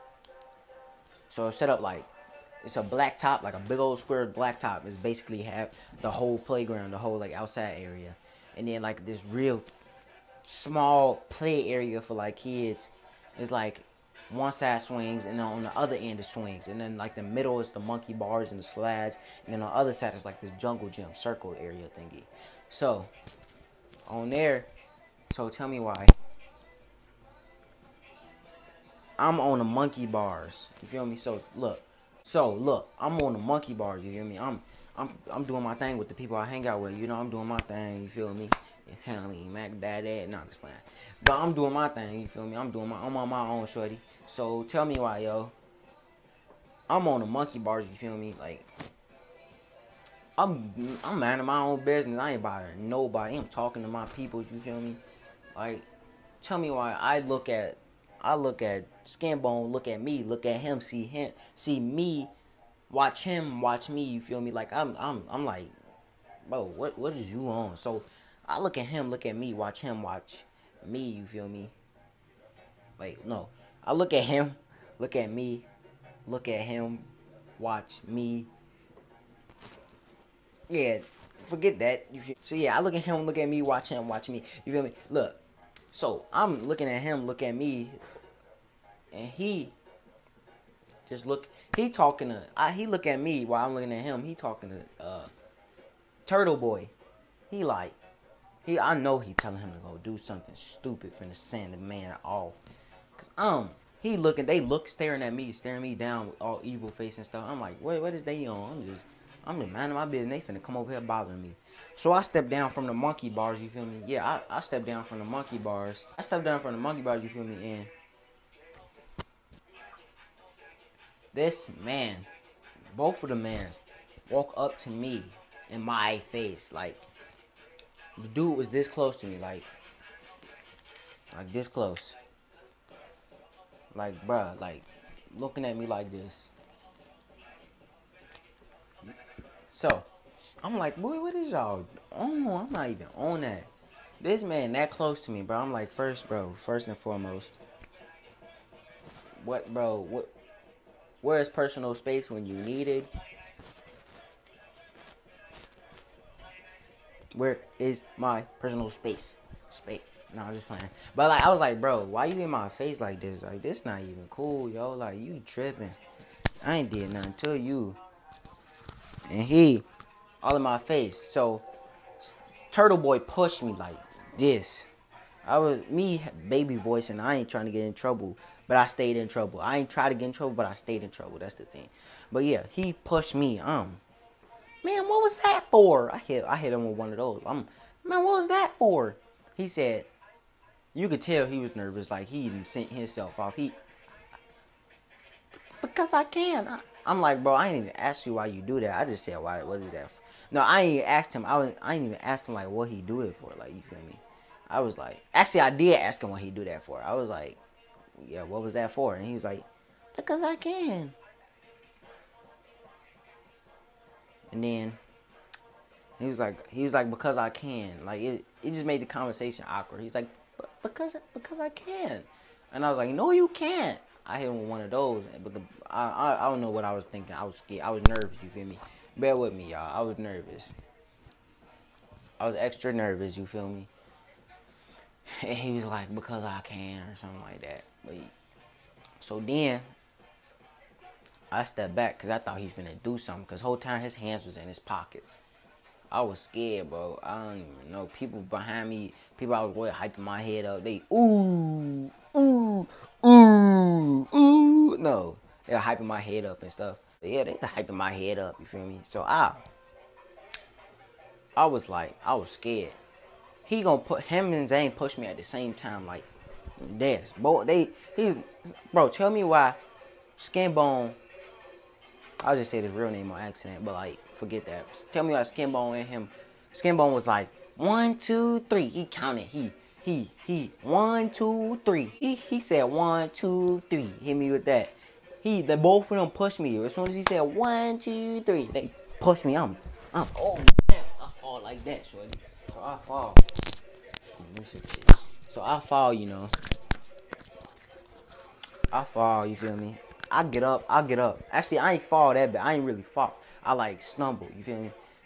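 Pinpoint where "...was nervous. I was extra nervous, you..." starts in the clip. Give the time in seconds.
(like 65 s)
230 s.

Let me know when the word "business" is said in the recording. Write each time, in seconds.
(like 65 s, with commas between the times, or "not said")
51 s, 110 s.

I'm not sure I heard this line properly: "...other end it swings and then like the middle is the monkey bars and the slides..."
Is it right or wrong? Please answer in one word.
right.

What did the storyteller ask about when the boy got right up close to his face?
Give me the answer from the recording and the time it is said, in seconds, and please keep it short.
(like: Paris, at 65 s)
where is personal space, at 151 s.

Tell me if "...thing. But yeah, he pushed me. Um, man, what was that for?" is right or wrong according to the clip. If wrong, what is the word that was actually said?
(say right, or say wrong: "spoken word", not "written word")
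right.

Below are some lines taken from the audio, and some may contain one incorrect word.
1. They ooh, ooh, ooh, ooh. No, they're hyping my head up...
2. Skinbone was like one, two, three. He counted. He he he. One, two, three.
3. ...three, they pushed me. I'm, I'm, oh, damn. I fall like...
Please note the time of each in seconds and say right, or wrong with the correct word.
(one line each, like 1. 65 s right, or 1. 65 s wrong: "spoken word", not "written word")
1. 250 s right
2. 276 s right
3. 288 s right.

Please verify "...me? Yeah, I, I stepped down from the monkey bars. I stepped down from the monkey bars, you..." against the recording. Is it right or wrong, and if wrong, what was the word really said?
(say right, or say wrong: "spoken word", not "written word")
right.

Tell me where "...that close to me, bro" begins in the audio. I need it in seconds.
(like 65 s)
144 s.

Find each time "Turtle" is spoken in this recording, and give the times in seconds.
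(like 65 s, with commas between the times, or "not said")
96 s, 172 s.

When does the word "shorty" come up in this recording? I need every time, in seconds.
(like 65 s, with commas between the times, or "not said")
43 s, 292 s.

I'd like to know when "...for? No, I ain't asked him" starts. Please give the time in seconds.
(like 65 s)
200 s.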